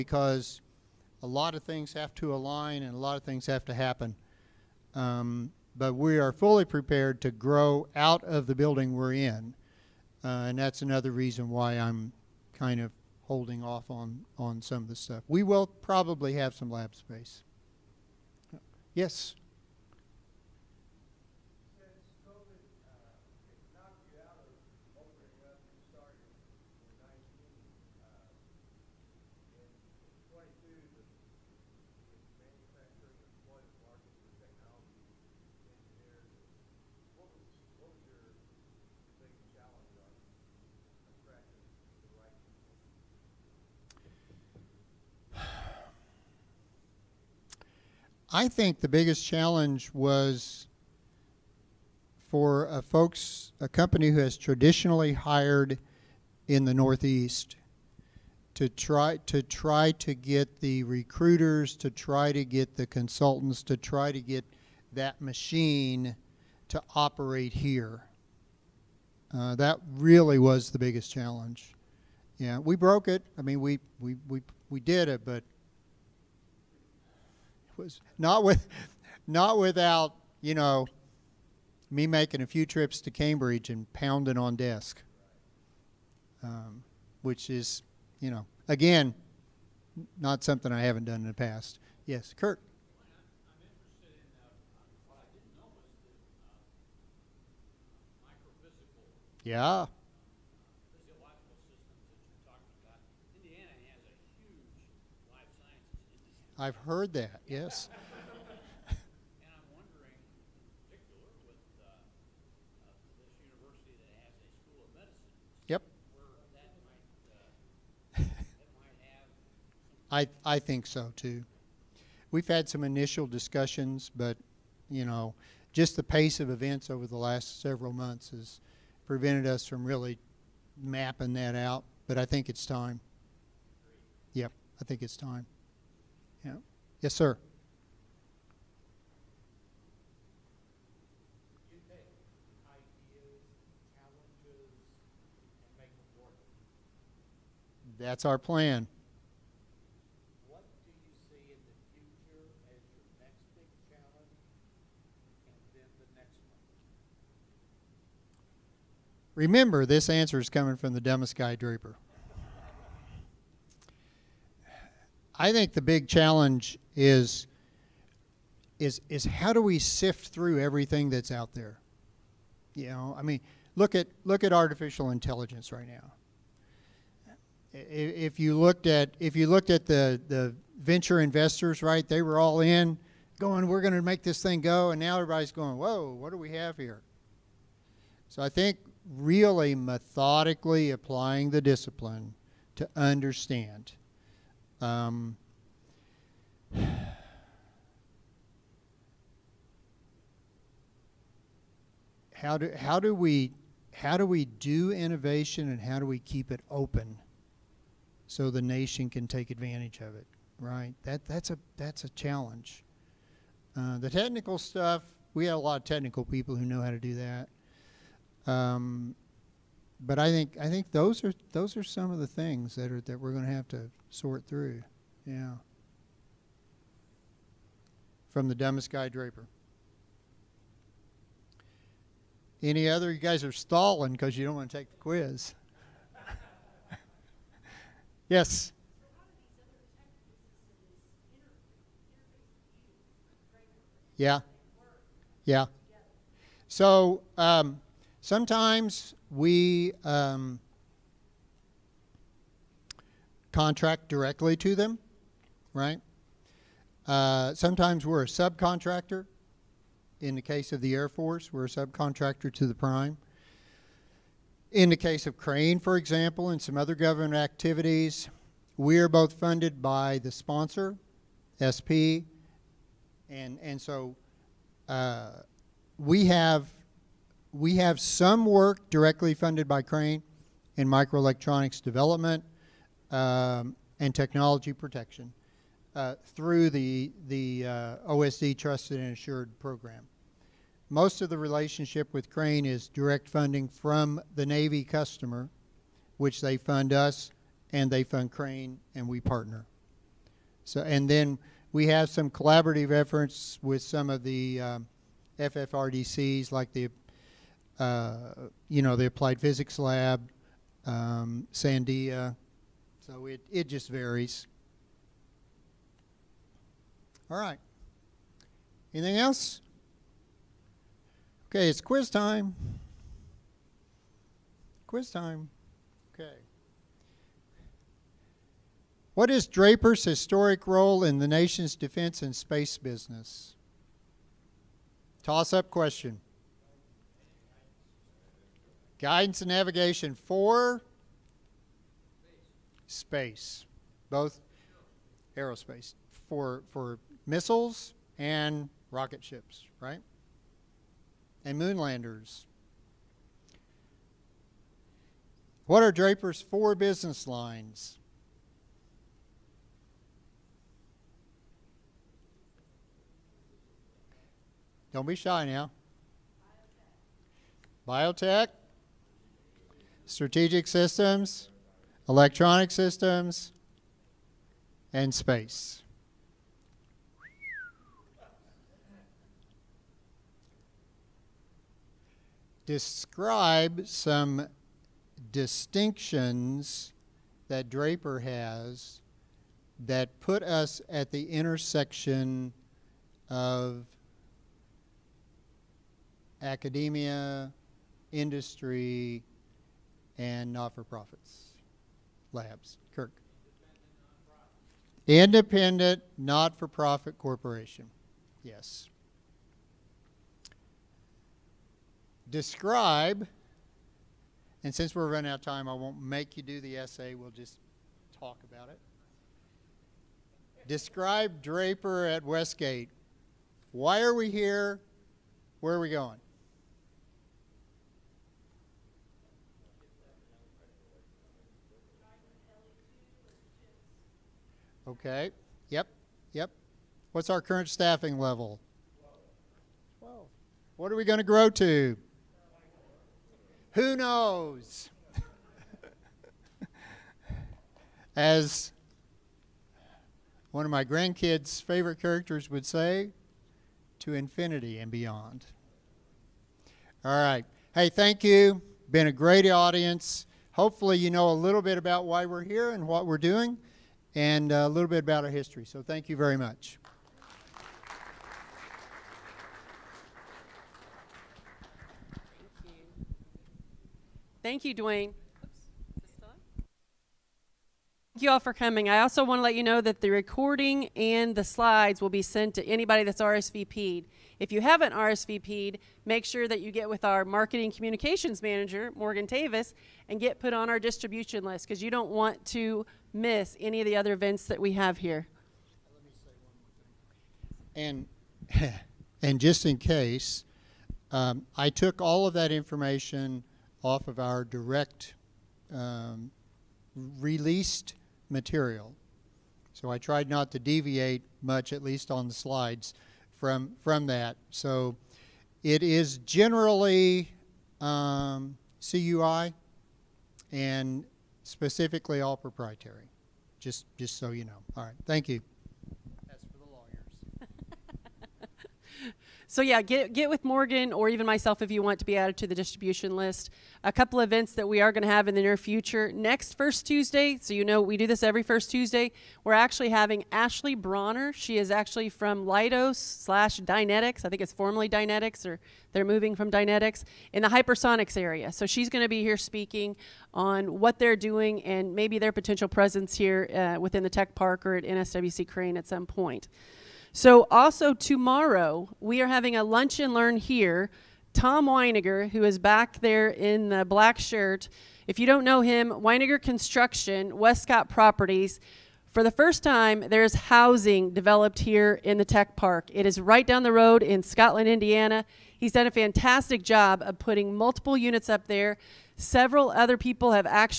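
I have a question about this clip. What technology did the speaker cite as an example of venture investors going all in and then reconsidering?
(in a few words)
Artificial intelligence.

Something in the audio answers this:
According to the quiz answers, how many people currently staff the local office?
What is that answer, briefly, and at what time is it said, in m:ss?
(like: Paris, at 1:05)
12, at 7:19.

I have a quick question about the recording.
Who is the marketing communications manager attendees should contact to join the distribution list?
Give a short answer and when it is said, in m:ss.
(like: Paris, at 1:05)
Morgan Tavis, at 8:08.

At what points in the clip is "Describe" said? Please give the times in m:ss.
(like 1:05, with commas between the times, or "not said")
6:22, 6:52, 7:00.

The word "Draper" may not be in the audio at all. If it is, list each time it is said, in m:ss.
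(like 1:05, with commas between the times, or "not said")
2:41, 3:49, 5:29, 5:55, 6:27, 7:01.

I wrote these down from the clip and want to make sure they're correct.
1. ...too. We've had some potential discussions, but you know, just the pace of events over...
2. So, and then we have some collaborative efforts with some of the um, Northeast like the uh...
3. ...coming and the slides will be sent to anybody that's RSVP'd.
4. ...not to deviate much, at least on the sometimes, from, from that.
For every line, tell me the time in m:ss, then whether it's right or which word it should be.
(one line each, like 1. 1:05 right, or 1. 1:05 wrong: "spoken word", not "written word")
1. 2:01 wrong: "initial", not "potential"
2. 5:00 wrong: "FFRDCs", not "Northeast"
3. 8:00 wrong: "recording", not "coming"
4. 8:30 wrong: "slides", not "sometimes".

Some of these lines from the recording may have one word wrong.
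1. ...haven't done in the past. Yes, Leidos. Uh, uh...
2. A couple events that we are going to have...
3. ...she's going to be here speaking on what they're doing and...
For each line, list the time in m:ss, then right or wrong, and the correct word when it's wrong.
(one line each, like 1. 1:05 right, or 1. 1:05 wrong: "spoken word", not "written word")
1. 1:30 wrong: "Kurt", not "Leidos"
2. 8:53 right
3. 9:08 right.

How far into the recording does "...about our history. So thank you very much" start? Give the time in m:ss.
7:44.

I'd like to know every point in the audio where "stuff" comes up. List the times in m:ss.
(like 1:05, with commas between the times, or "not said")
0:14, 3:34.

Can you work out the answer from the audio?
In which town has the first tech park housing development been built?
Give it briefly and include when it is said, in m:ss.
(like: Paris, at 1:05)
Scotland, Indiana, at 9:34.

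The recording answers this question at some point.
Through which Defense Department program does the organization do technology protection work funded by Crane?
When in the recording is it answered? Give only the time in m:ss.
4:48.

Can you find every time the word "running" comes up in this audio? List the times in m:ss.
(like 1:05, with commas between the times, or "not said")
6:55.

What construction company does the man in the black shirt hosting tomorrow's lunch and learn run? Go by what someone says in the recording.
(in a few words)
Weiniger Construction.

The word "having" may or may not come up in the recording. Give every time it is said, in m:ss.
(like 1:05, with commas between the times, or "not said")
8:59, 9:19.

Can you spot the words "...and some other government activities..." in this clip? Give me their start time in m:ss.
4:26.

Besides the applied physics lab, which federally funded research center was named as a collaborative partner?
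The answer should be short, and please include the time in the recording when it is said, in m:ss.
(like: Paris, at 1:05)
Sandia, at 5:11.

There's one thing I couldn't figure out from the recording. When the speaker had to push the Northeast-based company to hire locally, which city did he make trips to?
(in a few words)
Cambridge.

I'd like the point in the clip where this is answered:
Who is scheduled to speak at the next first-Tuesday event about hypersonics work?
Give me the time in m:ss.
9:00.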